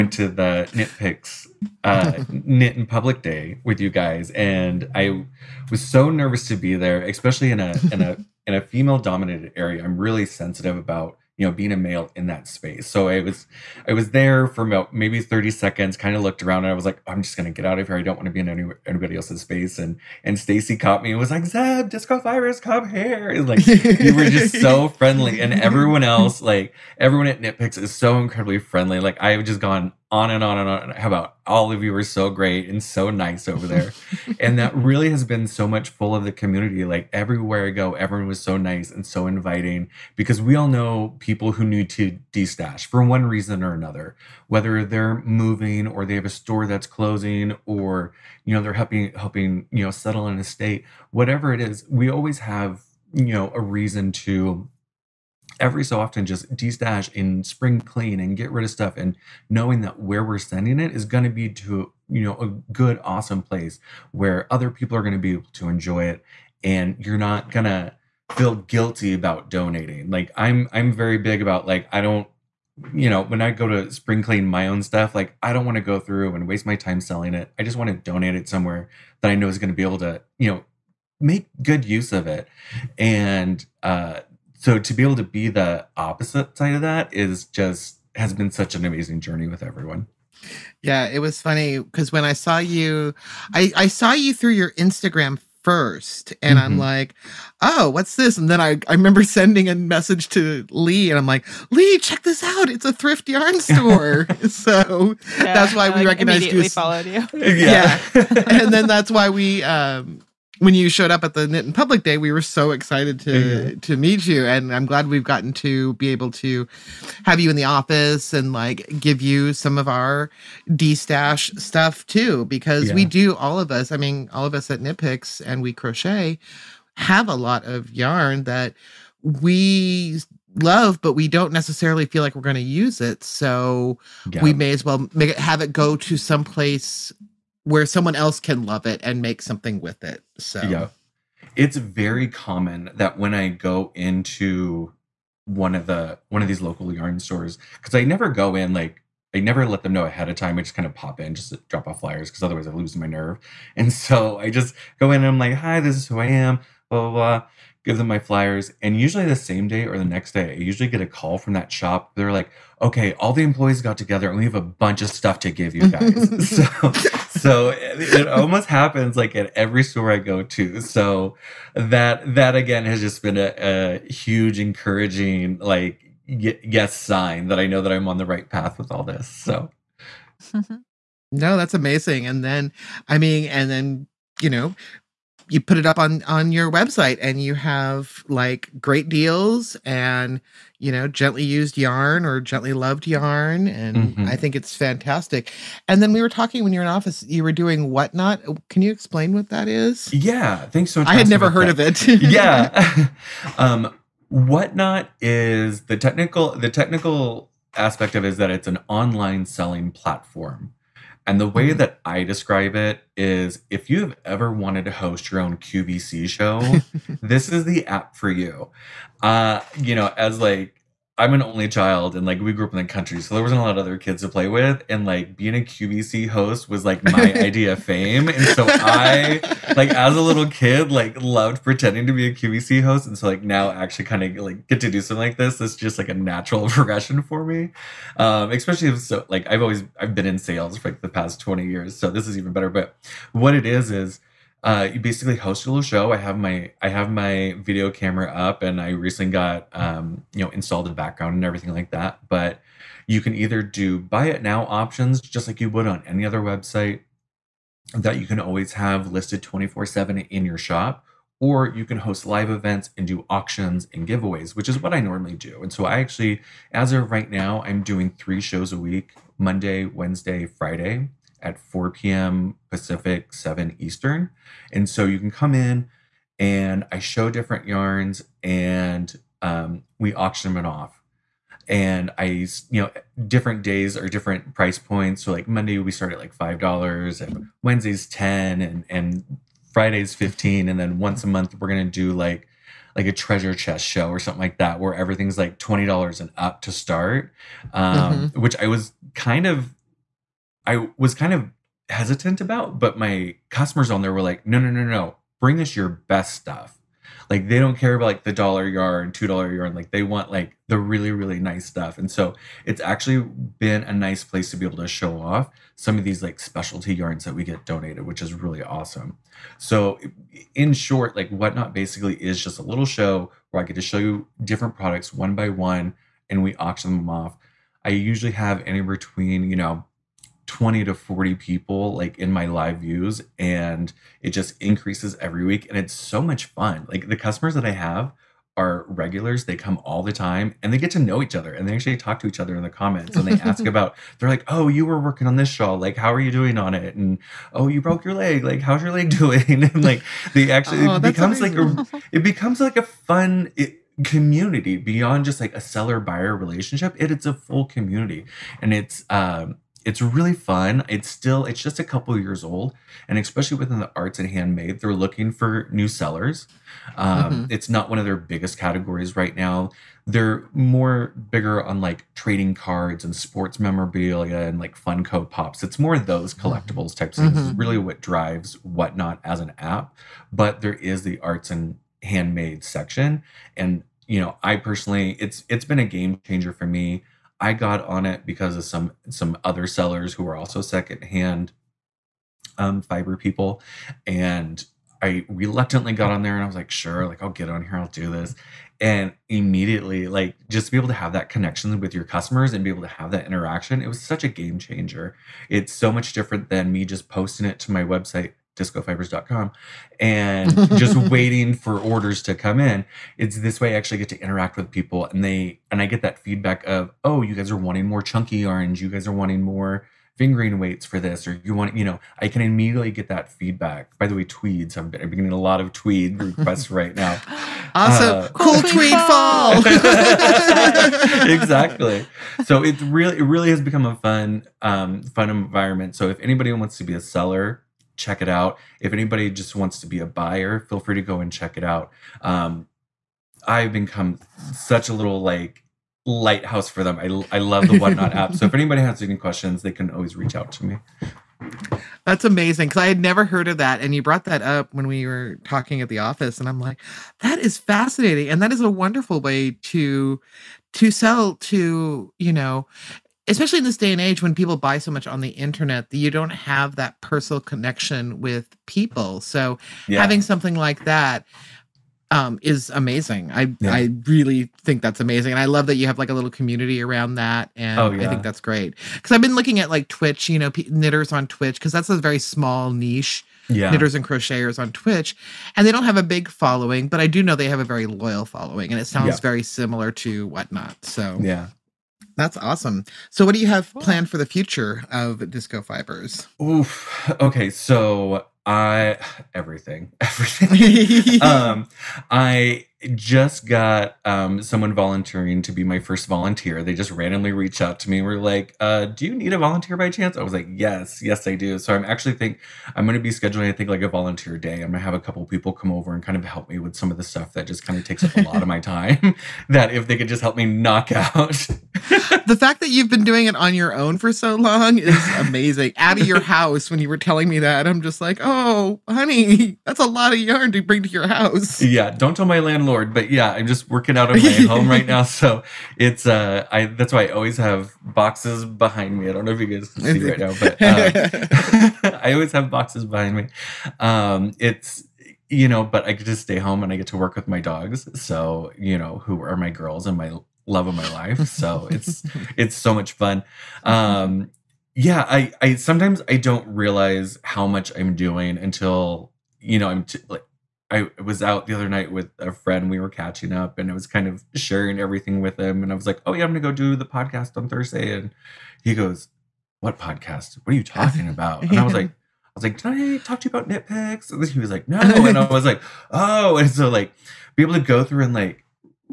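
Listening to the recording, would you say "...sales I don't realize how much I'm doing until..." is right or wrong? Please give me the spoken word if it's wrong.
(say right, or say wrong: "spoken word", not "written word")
wrong: "sometimes", not "sales".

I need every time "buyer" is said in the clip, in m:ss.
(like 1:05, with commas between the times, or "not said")
5:55, 7:20.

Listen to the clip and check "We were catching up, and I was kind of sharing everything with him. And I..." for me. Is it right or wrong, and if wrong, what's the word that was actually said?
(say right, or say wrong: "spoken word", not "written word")
right.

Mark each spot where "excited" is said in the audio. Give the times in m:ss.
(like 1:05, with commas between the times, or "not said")
1:52.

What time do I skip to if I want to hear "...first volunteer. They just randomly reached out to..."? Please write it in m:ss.
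8:25.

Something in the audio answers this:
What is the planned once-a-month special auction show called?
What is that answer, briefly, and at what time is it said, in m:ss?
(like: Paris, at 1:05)
treasure chest show, at 4:53.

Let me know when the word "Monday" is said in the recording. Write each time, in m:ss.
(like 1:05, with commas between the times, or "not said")
4:29, 4:45.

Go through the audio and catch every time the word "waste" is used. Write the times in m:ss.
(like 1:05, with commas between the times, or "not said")
1:16.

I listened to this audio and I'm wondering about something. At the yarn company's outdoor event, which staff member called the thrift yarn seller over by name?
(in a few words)
Stacey.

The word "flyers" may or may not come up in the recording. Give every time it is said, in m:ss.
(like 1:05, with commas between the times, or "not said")
2:31, 2:38.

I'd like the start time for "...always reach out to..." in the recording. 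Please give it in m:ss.
7:29.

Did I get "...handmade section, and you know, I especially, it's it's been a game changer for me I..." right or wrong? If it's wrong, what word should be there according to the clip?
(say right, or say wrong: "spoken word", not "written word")
wrong: "personally", not "especially".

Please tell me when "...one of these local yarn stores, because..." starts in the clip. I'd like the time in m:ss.
2:26.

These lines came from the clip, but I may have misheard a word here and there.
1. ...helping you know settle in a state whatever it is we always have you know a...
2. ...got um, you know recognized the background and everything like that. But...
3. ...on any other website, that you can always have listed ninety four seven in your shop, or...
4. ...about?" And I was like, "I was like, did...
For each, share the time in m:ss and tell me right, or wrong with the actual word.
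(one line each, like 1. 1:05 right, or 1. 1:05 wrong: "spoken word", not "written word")
1. 0:49 right
2. 4:09 wrong: "installed", not "recognized"
3. 4:15 wrong: "twenty", not "ninety"
4. 9:31 right.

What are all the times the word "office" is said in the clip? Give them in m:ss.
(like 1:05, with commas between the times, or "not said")
1:57, 3:16, 7:35.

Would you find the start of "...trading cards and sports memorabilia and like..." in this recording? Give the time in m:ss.
6:12.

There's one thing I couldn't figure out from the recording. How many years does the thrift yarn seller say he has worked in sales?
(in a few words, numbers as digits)
20.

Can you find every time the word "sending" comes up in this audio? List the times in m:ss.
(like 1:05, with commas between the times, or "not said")
1:00, 1:39.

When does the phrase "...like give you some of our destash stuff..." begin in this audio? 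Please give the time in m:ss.
1:58.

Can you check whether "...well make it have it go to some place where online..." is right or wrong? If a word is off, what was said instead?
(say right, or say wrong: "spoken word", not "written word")
wrong: "someone", not "online".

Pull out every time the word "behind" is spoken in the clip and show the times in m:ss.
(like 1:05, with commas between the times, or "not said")
8:58, 9:02.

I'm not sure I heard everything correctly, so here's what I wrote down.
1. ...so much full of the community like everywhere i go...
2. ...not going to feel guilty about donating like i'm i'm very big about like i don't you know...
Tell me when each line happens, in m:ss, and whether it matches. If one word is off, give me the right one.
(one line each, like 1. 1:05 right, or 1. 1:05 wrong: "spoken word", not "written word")
1. 0:35 right
2. 1:07 right.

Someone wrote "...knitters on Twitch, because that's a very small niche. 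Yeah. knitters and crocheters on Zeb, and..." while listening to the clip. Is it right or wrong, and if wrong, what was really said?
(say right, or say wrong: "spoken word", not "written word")
wrong: "Twitch", not "Zeb".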